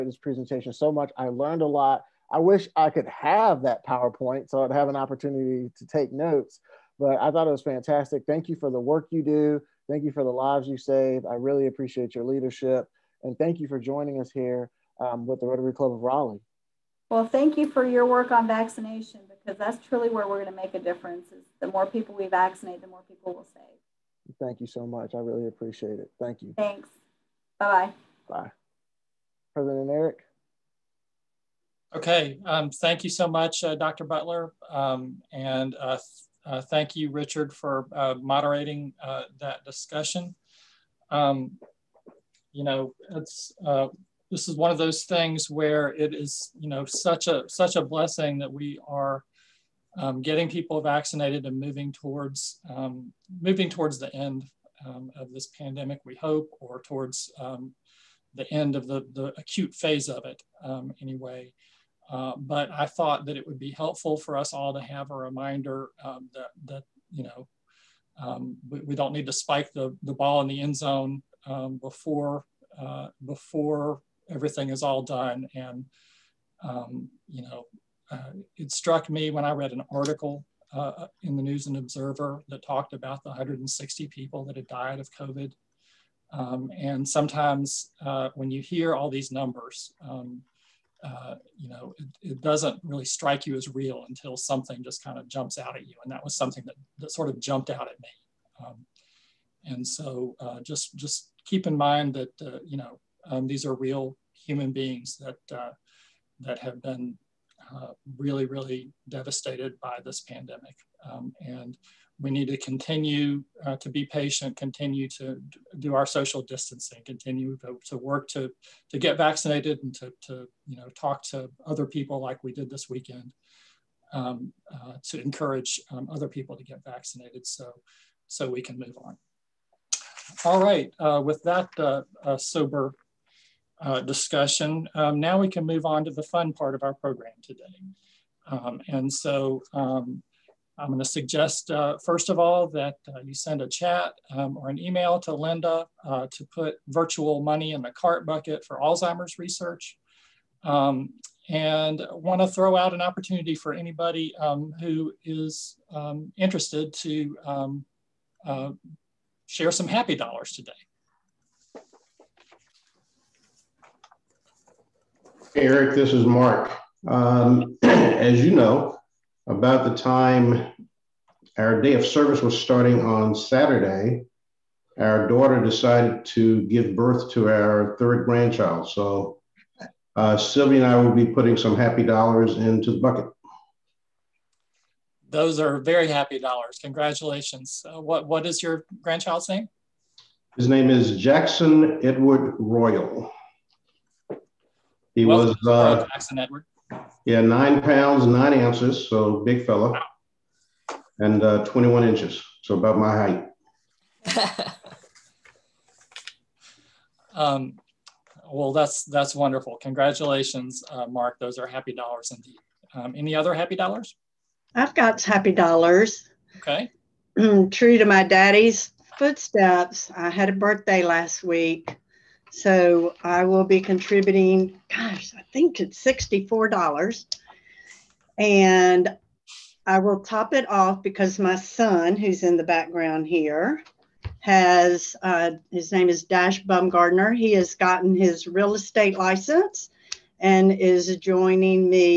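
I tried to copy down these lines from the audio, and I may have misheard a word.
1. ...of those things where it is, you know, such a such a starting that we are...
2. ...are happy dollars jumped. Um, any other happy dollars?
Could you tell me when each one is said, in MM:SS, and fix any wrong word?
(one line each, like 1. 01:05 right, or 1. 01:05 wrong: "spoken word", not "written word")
1. 00:44 wrong: "blessing", not "starting"
2. 03:31 wrong: "indeed", not "jumped".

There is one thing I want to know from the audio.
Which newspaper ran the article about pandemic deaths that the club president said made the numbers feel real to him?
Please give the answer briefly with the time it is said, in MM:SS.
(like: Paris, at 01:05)
News and Observer, at 01:21.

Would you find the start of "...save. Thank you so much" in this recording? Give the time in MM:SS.
00:23.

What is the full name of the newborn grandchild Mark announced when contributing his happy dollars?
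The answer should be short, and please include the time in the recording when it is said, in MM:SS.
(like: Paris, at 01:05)
Jackson Edward Royal, at 03:11.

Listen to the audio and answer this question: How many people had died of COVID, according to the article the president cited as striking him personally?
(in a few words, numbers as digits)
160.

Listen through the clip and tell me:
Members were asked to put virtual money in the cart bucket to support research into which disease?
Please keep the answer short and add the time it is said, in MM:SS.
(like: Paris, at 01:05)
Alzheimer's, at 02:28.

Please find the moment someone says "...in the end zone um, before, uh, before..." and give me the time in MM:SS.
01:10.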